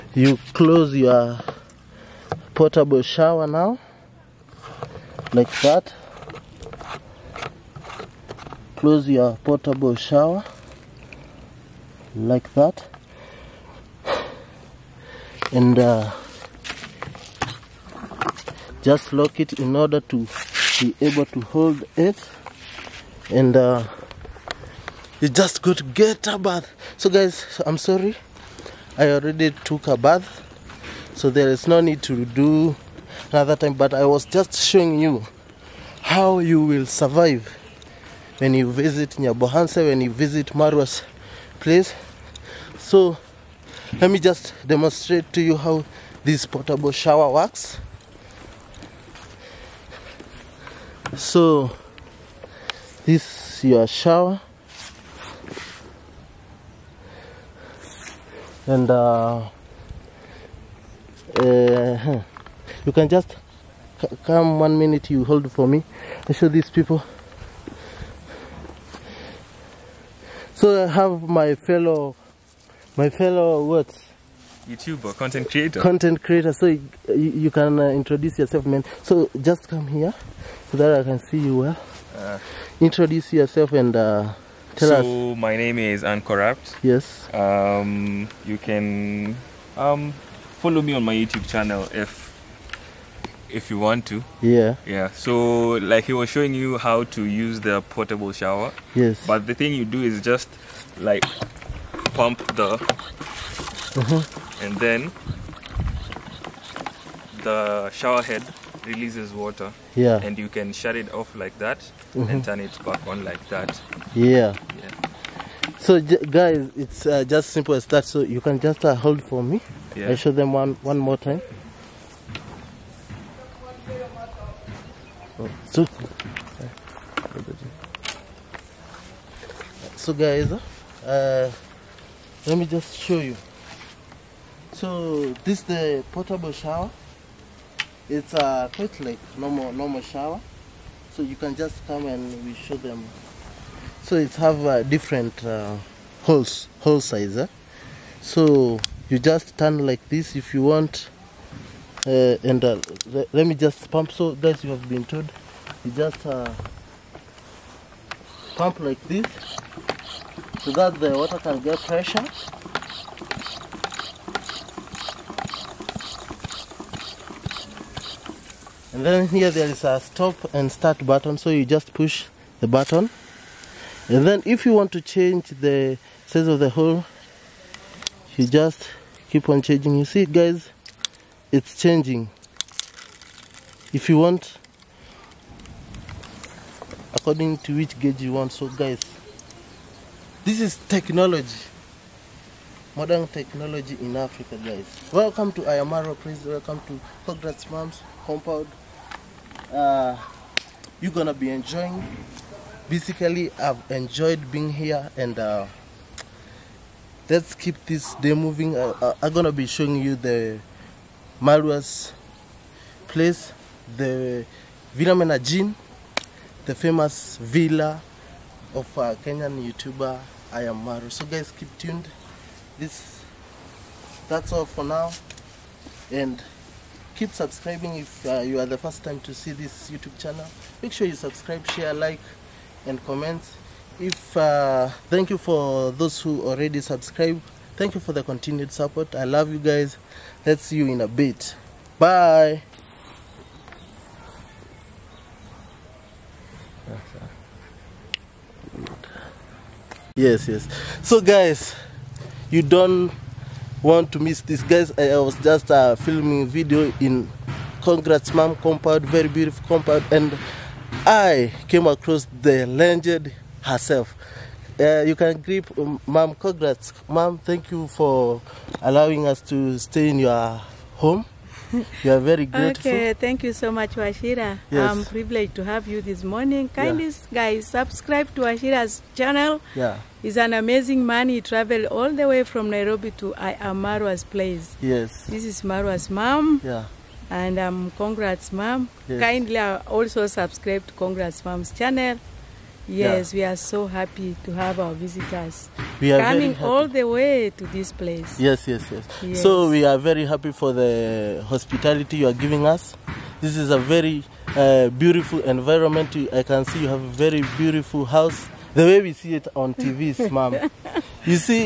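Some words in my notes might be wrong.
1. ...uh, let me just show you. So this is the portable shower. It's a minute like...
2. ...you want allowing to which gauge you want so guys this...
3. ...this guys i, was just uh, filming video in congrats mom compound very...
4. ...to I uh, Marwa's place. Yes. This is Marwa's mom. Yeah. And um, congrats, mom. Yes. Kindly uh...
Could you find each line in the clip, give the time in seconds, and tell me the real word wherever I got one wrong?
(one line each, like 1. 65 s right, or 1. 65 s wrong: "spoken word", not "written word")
1. 131 s wrong: "quite", not "minute"
2. 184 s wrong: "according", not "allowing"
3. 254 s right
4. 283 s right.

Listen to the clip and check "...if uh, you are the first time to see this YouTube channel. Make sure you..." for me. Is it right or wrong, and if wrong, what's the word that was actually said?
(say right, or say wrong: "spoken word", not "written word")
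right.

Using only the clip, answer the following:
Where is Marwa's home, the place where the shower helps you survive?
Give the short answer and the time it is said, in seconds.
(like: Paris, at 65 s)
Nyabohanse, at 39 s.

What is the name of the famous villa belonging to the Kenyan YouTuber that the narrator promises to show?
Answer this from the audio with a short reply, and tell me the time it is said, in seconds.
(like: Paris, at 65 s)
Villa Menajin, at 214 s.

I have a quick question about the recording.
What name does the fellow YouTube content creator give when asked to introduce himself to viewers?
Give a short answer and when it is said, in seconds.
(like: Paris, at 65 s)
Uncorrupt, at 86 s.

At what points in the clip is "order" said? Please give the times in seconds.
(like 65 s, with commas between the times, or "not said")
19 s.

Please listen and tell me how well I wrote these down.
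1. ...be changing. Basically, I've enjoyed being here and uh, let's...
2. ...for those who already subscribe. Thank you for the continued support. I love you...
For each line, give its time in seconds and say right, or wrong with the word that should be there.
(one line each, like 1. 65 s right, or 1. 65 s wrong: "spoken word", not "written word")
1. 201 s wrong: "enjoying", not "changing"
2. 235 s right.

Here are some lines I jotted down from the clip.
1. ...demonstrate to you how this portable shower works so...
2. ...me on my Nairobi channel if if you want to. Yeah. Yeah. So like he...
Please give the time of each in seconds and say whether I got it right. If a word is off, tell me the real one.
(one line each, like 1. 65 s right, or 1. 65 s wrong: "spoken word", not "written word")
1. 44 s right
2. 90 s wrong: "YouTube", not "Nairobi".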